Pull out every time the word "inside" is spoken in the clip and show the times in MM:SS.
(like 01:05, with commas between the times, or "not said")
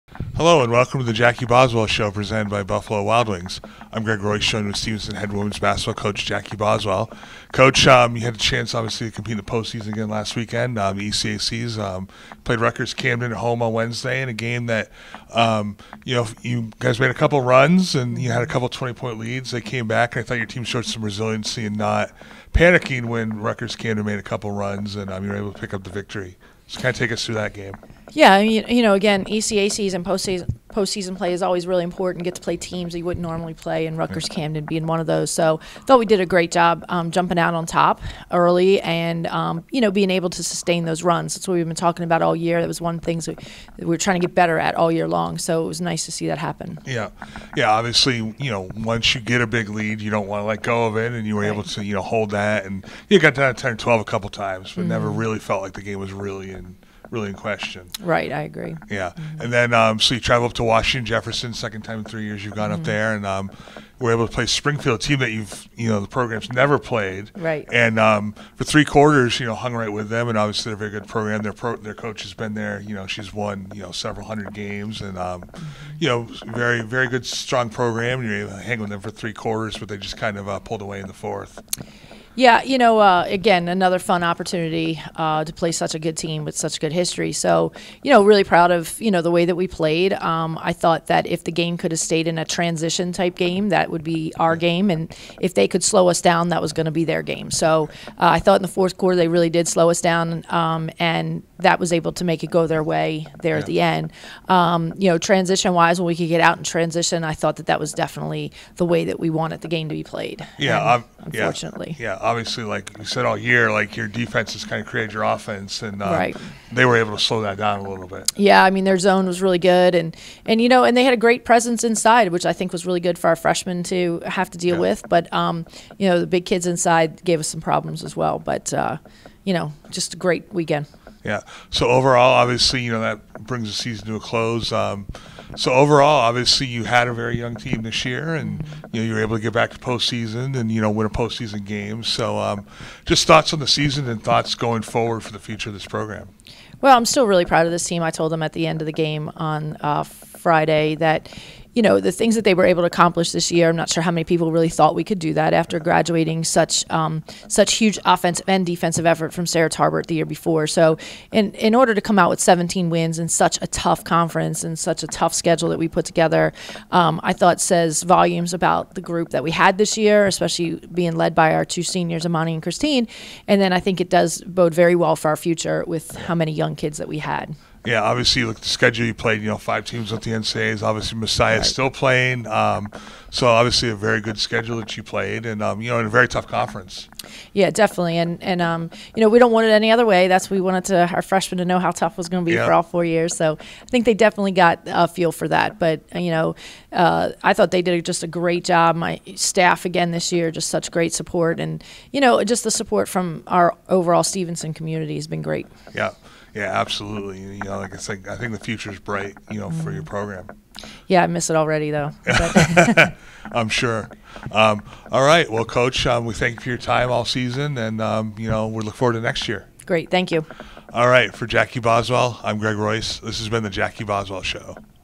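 02:01, 02:06.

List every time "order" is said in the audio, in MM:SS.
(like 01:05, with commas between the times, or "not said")
02:41.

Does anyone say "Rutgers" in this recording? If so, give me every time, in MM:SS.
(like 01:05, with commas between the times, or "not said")
00:12, 00:23, 00:33.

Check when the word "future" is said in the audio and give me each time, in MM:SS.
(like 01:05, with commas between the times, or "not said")
02:25, 02:55, 03:28.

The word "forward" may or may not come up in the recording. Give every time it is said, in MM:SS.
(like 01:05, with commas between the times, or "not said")
02:24, 03:38.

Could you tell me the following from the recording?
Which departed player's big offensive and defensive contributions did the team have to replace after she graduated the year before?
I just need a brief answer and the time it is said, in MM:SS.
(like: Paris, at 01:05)
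Sarah Tarbert, at 02:39.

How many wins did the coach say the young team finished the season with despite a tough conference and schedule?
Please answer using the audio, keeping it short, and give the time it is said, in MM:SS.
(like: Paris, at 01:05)
17, at 02:42.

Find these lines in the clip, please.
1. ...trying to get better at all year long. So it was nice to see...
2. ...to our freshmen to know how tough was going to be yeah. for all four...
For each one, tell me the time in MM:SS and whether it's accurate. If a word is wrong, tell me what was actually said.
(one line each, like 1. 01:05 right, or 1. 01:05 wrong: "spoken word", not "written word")
1. 00:43 right
2. 03:10 right.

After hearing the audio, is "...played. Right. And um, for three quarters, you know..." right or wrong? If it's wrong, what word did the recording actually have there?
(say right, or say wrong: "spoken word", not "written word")
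right.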